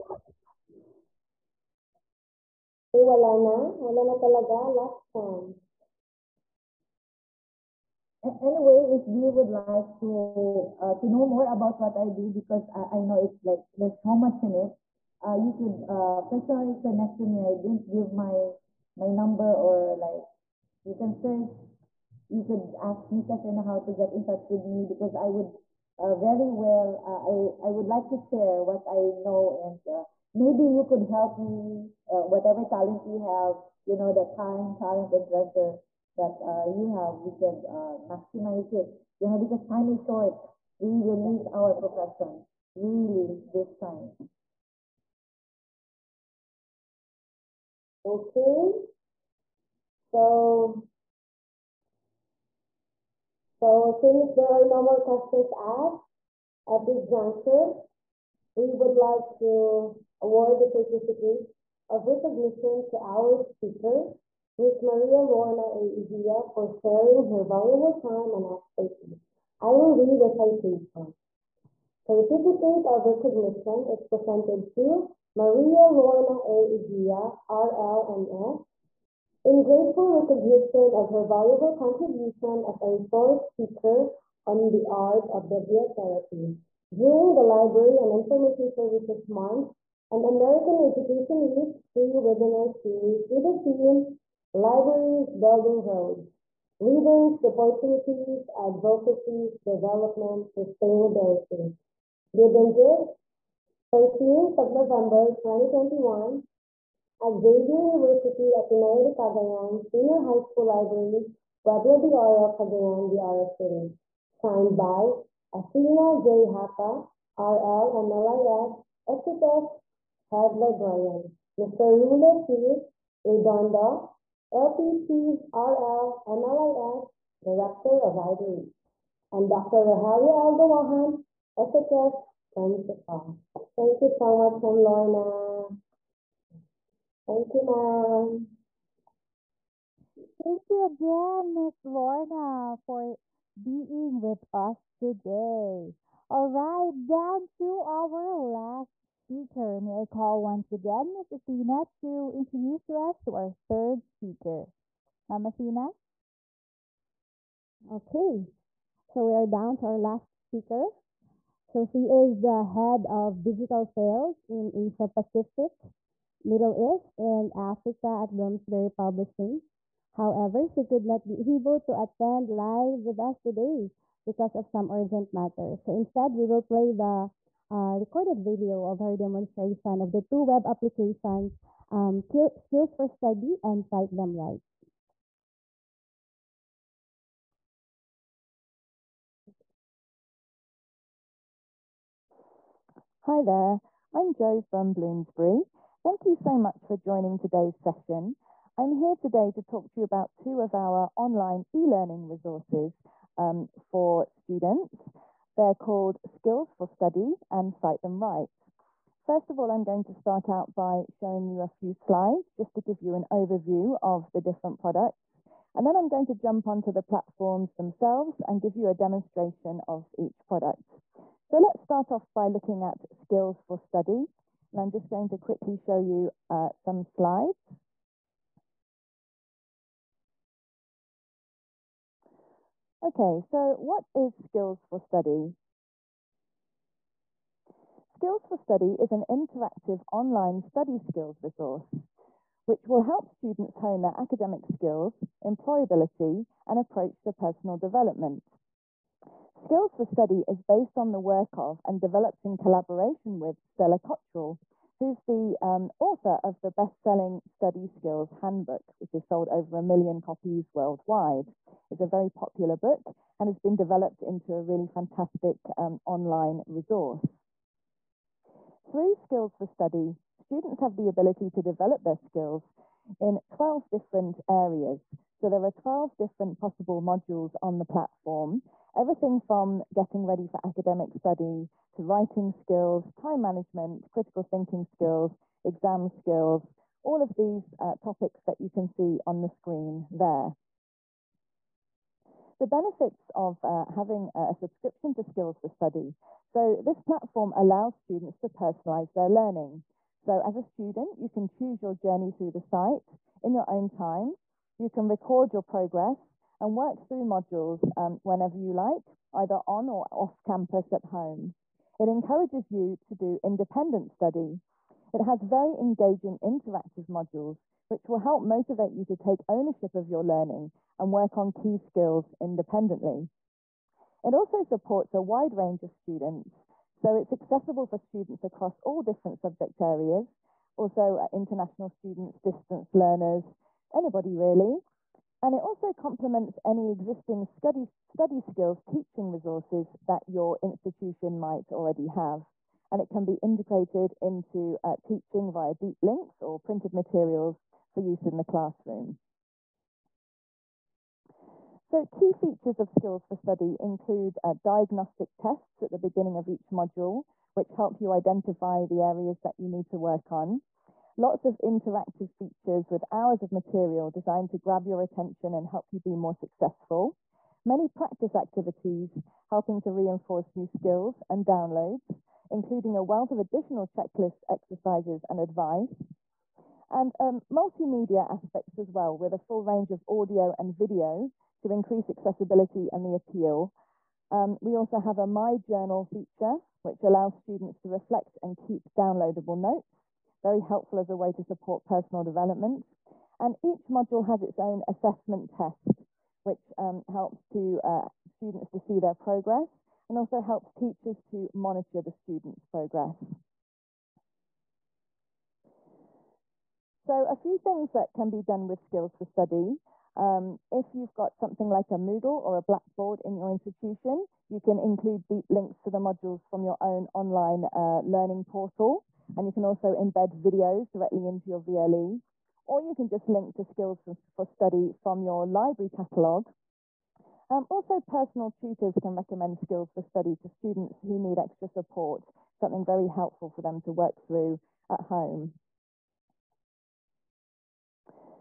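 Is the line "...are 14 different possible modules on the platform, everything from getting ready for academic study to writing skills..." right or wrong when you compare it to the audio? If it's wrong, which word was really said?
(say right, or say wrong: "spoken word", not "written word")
wrong: "12", not "14".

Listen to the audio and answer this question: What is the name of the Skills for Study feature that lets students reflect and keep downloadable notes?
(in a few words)
My Journal.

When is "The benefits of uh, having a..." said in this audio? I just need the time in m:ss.
4:52.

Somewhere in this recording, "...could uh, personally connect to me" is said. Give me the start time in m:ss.
0:15.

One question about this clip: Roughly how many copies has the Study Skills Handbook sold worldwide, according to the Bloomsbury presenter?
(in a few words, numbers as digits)
over a million.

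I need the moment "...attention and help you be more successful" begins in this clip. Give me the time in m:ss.
6:05.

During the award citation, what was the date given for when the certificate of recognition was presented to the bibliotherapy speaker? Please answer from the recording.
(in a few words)
13th of November 2021.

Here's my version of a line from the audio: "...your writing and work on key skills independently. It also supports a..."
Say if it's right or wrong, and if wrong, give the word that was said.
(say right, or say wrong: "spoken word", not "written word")
wrong: "learning", not "writing".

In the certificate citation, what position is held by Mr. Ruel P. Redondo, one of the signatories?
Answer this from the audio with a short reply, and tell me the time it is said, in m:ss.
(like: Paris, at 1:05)
Director of Libraries, at 2:07.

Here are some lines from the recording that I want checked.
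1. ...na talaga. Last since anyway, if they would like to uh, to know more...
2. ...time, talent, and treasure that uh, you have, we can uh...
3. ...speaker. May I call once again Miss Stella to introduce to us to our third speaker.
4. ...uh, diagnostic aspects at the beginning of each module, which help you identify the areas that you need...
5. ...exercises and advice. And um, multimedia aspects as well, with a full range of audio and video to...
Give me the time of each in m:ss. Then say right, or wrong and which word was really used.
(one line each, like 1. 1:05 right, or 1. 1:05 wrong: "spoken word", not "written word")
1. 0:04 wrong: "chance", not "since"
2. 0:34 right
3. 2:29 wrong: "Athena", not "Stella"
4. 5:54 wrong: "tests", not "aspects"
5. 6:14 right.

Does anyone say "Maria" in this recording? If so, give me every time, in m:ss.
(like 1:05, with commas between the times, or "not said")
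1:04, 1:15.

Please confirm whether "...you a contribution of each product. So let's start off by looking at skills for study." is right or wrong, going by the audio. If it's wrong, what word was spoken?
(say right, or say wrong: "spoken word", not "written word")
wrong: "demonstration", not "contribution".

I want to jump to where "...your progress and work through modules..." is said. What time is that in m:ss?
5:05.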